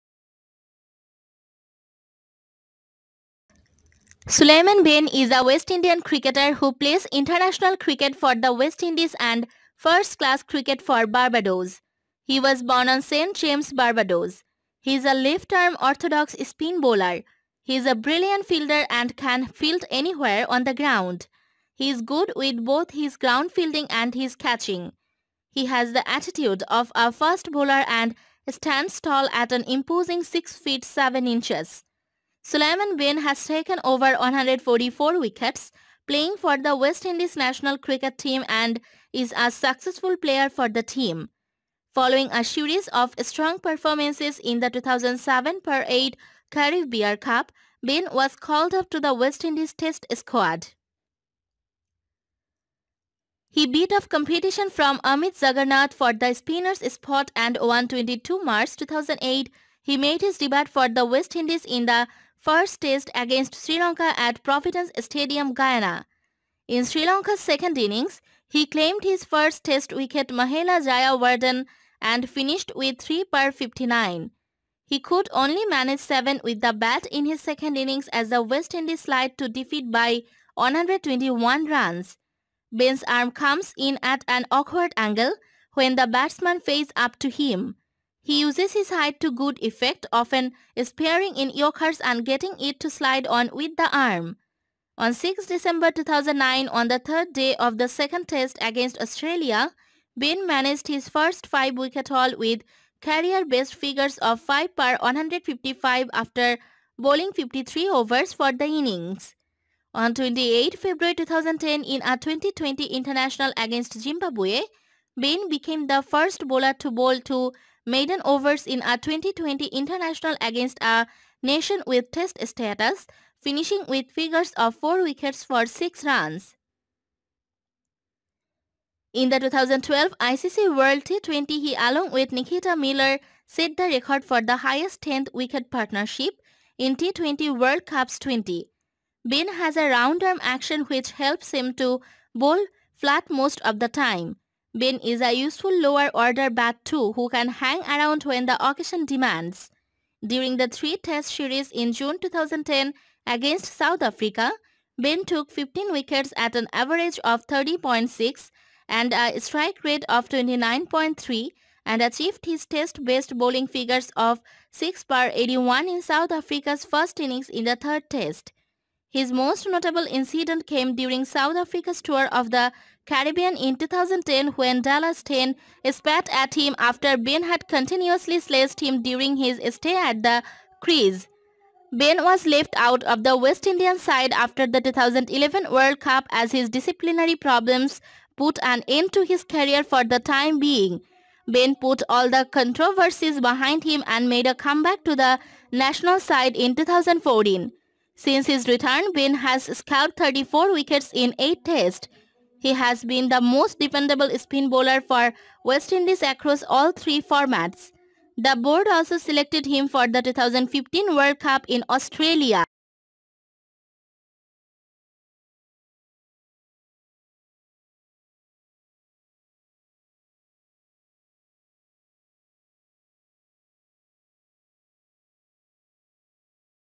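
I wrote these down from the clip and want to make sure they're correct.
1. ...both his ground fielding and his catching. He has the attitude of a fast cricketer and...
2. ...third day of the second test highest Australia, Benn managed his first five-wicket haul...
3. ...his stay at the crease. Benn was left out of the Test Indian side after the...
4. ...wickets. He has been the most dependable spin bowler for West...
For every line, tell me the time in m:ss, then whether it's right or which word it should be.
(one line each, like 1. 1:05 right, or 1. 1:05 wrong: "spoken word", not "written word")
1. 0:22 wrong: "bowler", not "cricketer"
2. 1:36 wrong: "against", not "highest"
3. 2:59 wrong: "West", not "Test"
4. 3:21 wrong: "tests", not "wickets".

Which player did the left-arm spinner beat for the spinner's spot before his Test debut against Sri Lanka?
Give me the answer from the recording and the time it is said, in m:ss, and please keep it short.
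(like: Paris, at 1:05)
Amit Jaggernauth, at 0:54.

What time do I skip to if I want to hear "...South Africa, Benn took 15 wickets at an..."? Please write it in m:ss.
2:33.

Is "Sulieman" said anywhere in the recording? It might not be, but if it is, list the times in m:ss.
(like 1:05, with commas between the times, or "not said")
0:04, 0:32.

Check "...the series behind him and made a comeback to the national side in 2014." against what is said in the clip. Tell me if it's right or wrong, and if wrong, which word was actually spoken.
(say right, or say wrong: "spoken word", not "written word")
wrong: "controversies", not "series".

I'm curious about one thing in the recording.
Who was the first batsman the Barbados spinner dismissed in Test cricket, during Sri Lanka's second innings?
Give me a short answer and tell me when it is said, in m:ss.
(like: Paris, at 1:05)
Mahela Jayawardene, at 1:10.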